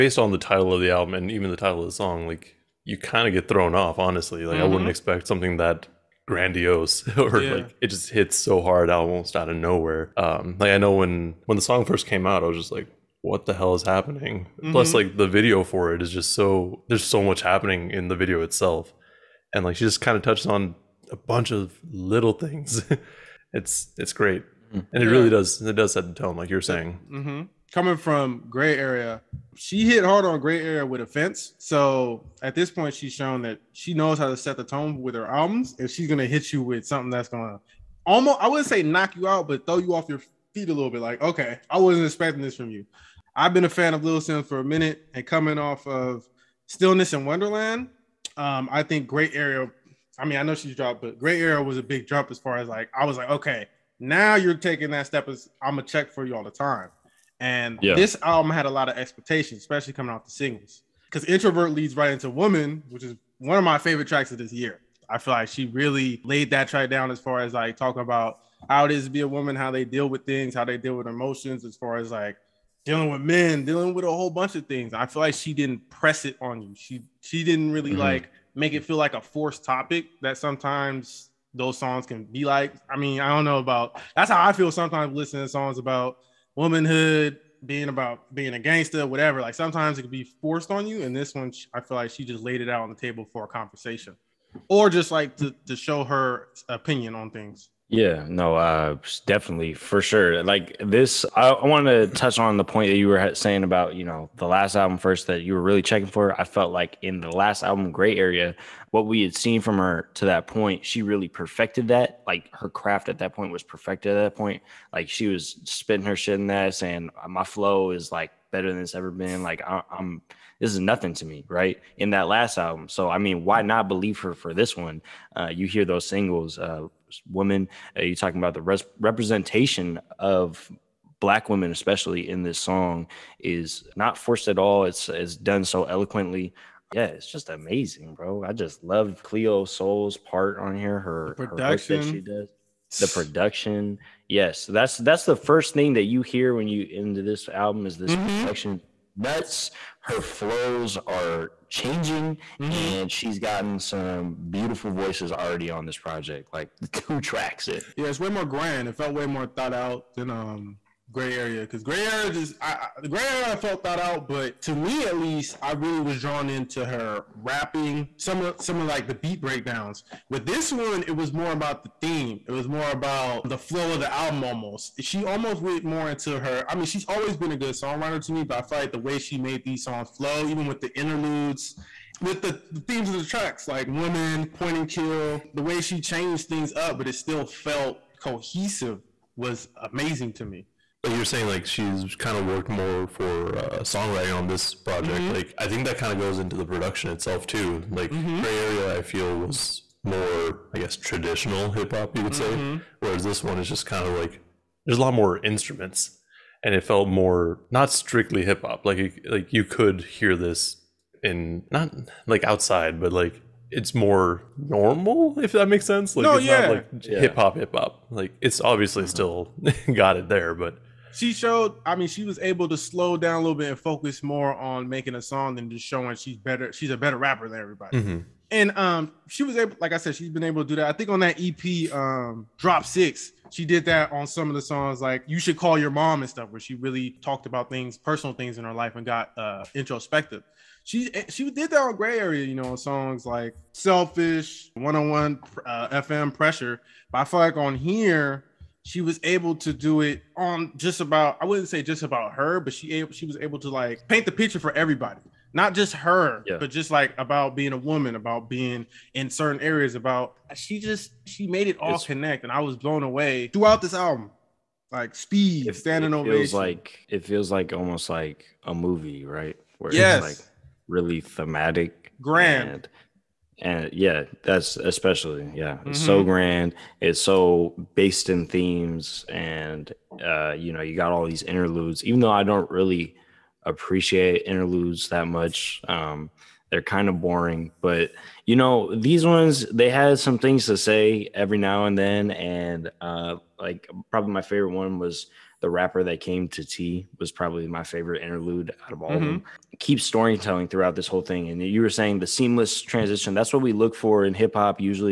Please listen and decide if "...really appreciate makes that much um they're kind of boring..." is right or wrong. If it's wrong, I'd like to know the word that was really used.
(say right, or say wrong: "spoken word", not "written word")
wrong: "interludes", not "makes".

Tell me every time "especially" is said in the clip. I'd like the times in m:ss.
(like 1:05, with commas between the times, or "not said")
0:59, 2:11, 4:34.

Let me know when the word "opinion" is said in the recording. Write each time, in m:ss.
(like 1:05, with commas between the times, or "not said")
1:36.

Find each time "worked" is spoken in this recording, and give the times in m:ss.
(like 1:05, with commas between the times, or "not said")
3:12.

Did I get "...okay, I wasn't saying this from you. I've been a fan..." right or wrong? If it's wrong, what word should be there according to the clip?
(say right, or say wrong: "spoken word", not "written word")
wrong: "expecting", not "saying".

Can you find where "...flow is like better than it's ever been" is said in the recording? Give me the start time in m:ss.
1:57.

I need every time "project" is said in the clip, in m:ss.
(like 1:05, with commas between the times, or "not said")
2:35, 3:14.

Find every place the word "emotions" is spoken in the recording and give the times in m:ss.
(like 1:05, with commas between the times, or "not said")
1:11.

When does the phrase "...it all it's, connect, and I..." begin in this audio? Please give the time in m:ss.
4:21.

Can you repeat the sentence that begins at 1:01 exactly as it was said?
Because Introvert leads right into Woman, which is one of my favorite tracks of this year.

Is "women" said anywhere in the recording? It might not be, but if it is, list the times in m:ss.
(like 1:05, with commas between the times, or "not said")
2:07, 2:11.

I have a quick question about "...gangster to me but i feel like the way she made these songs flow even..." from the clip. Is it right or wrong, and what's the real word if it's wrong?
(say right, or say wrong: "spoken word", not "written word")
wrong: "songwriter", not "gangster".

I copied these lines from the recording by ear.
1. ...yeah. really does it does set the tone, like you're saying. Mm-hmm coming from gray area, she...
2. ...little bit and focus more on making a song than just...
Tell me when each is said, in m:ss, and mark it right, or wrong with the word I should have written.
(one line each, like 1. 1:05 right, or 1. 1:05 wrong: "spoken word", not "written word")
1. 0:25 right
2. 3:43 right.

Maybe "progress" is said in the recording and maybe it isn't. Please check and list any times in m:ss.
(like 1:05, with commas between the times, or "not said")
not said.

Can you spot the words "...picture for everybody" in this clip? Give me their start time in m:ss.
4:14.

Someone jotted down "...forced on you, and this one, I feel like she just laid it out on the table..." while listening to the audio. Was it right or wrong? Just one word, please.
right.